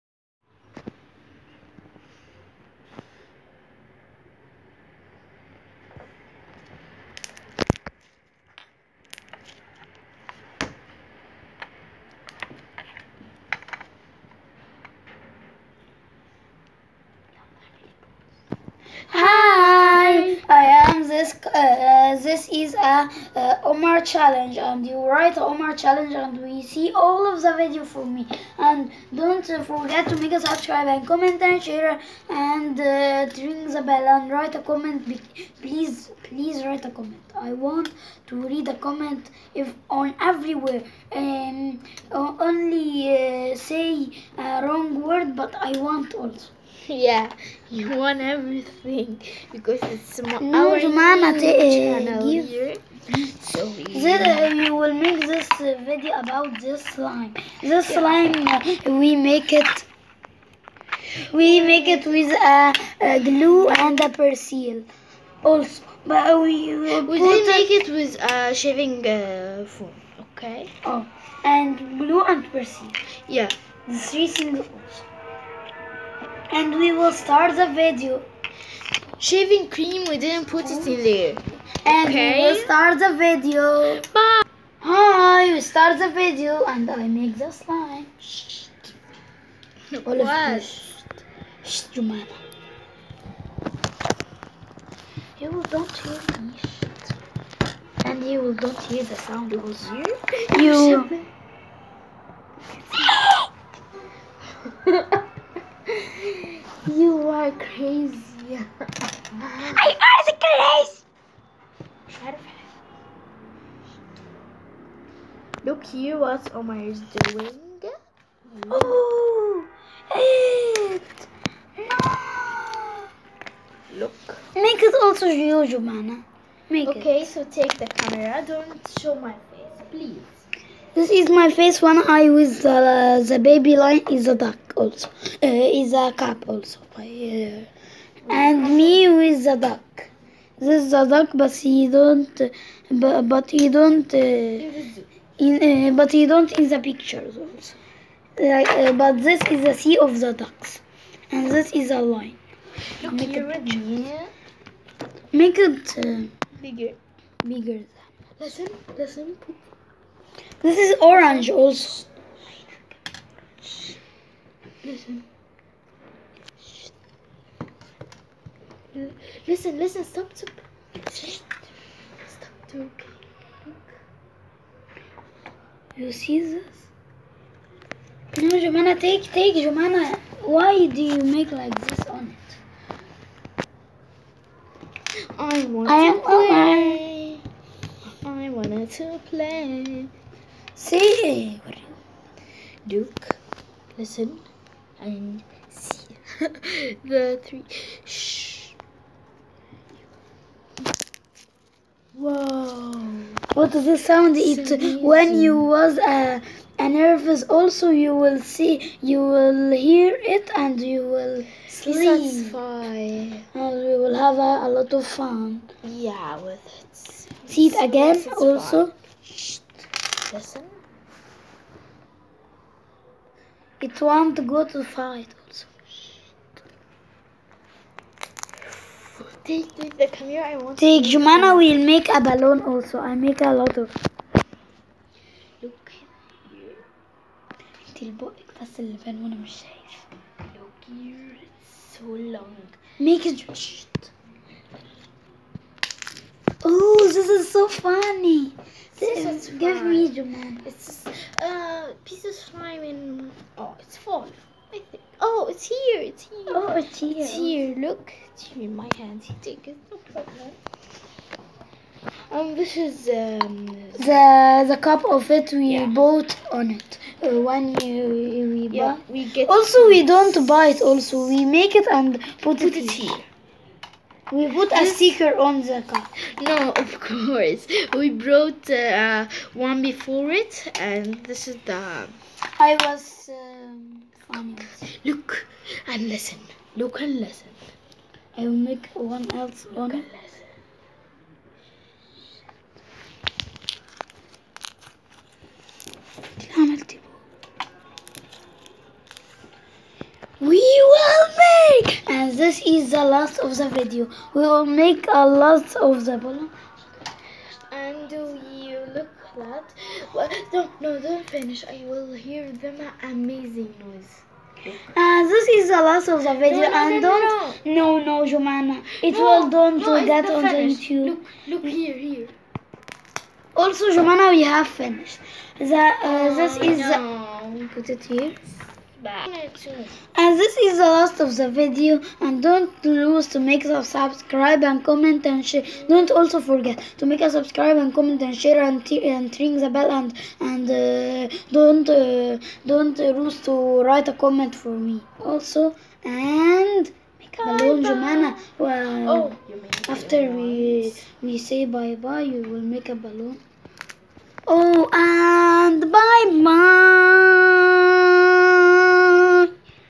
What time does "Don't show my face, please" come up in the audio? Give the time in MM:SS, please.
02:08.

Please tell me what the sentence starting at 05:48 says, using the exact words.
Well, oh, after we we say bye bye, you will make a balloon.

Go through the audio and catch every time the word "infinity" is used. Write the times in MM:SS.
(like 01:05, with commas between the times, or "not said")
not said.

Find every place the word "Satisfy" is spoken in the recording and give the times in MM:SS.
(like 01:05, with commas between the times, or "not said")
03:31, 03:38.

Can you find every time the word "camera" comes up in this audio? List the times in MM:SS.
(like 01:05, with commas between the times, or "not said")
02:07, 03:50.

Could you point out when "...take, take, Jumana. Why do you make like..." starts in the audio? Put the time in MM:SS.
02:58.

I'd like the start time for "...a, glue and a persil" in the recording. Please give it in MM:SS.
01:02.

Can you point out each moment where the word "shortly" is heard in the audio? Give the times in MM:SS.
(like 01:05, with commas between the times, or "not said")
not said.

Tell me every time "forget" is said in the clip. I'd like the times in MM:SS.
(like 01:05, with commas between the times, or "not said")
00:29, 05:36.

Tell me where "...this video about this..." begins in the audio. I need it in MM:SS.
00:55.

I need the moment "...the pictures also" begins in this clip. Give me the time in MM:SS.
02:26.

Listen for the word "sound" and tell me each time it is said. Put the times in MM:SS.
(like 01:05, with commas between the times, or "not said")
01:39, 03:23.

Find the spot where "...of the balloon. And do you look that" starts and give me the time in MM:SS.
05:05.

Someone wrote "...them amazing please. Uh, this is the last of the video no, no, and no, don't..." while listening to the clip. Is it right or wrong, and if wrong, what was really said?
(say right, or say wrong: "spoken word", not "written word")
wrong: "noise", not "please".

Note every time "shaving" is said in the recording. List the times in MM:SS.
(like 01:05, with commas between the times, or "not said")
01:08, 01:19.